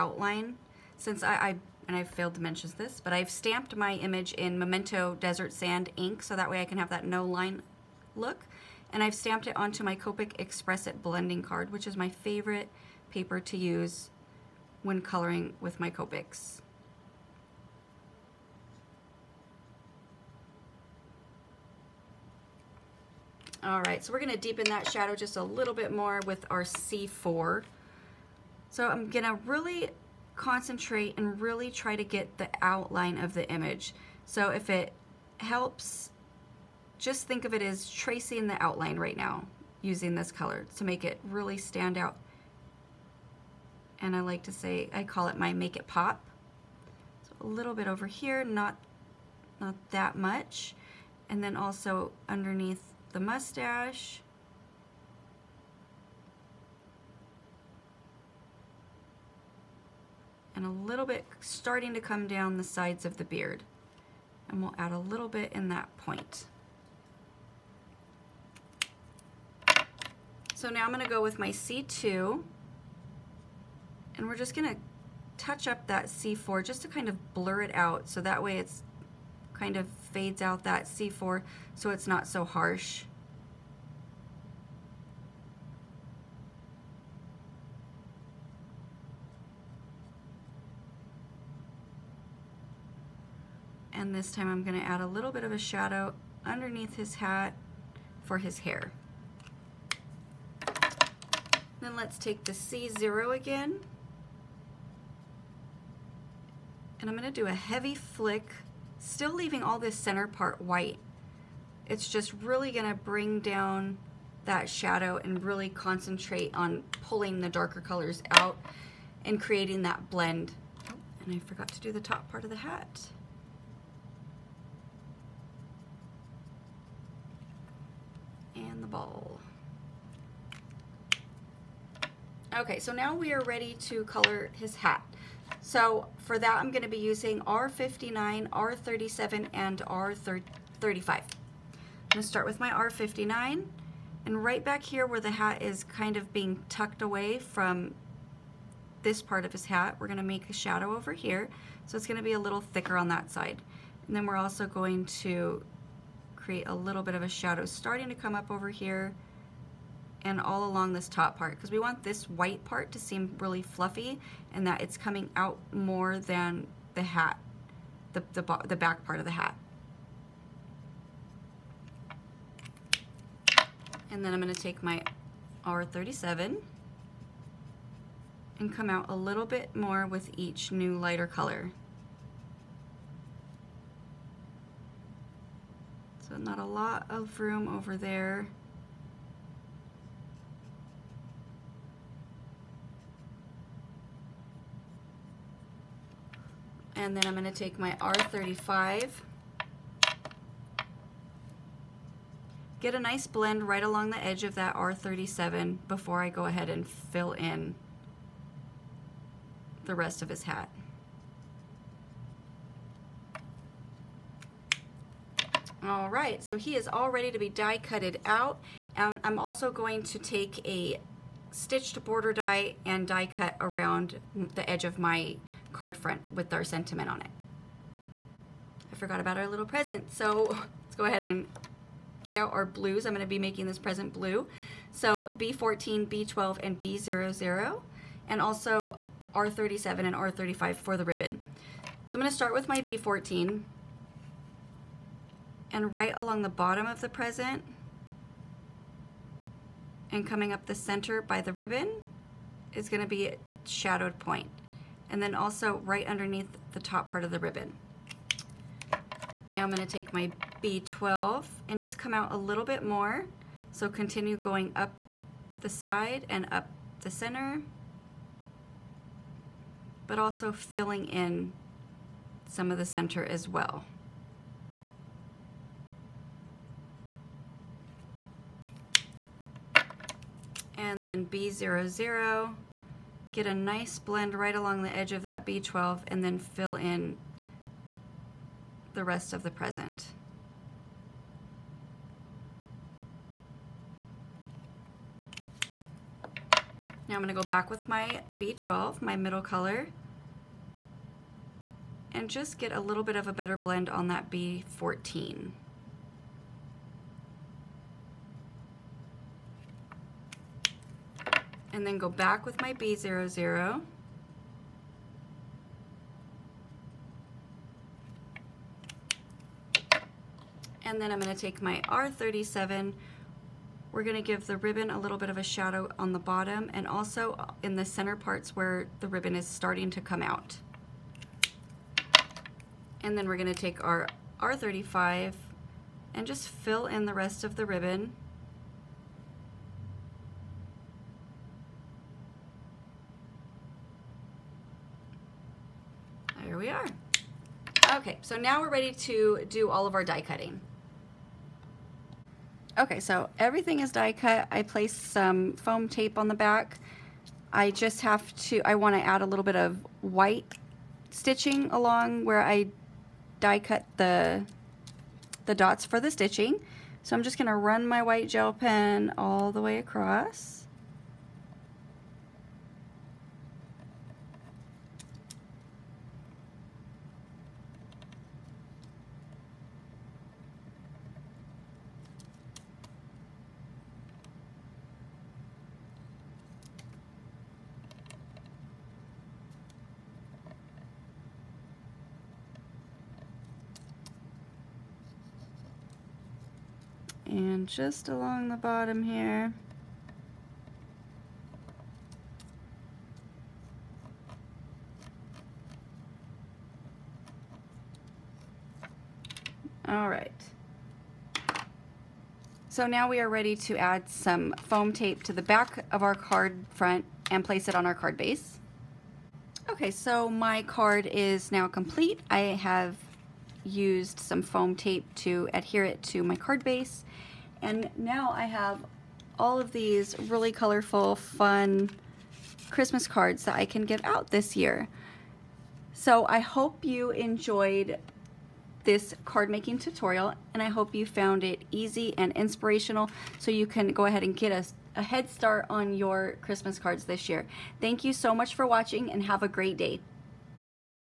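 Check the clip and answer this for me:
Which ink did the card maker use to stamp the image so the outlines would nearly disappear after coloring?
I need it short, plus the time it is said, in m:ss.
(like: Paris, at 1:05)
Memento Desert Sand, at 0:04.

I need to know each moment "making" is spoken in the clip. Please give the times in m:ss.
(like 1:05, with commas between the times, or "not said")
3:53, 7:19.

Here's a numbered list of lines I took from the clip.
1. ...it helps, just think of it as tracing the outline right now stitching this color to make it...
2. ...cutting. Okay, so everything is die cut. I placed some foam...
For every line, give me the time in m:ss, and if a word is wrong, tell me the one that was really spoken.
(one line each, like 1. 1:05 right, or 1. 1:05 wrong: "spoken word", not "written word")
1. 0:34 wrong: "using", not "stitching"
2. 5:50 right.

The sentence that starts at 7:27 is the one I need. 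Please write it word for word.
Thank you so much for watching and have a great day.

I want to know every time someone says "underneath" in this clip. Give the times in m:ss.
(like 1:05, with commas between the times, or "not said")
0:52, 1:36, 4:16.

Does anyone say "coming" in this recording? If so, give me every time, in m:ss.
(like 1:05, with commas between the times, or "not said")
2:44, 4:10.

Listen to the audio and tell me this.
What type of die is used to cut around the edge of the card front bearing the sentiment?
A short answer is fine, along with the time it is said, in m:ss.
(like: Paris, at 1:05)
stitched border die, at 3:41.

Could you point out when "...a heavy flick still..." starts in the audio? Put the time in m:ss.
1:47.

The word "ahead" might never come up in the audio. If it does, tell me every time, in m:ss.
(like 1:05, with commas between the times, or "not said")
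3:26, 3:51, 7:24.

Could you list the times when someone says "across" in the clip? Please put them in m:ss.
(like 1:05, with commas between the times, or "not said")
6:09.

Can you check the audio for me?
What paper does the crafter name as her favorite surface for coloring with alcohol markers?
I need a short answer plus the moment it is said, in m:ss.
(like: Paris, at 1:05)
Copic X-Press It blending card, at 0:09.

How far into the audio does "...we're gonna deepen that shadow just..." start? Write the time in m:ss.
0:24.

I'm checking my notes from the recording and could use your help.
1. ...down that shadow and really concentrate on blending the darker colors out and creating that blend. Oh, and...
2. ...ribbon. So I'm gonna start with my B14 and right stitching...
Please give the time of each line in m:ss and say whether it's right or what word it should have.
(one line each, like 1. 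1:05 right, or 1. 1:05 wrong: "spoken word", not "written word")
1. 1:53 wrong: "pulling", not "blending"
2. 4:01 wrong: "along", not "stitching".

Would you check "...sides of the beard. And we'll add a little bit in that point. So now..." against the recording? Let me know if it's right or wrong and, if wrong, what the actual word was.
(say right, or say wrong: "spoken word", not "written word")
right.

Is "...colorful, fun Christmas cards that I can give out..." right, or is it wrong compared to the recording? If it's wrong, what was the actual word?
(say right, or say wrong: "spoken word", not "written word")
right.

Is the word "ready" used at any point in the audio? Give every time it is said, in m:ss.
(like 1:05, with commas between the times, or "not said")
2:13, 3:37, 5:48, 6:53.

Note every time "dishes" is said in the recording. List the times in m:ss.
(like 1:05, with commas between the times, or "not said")
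not said.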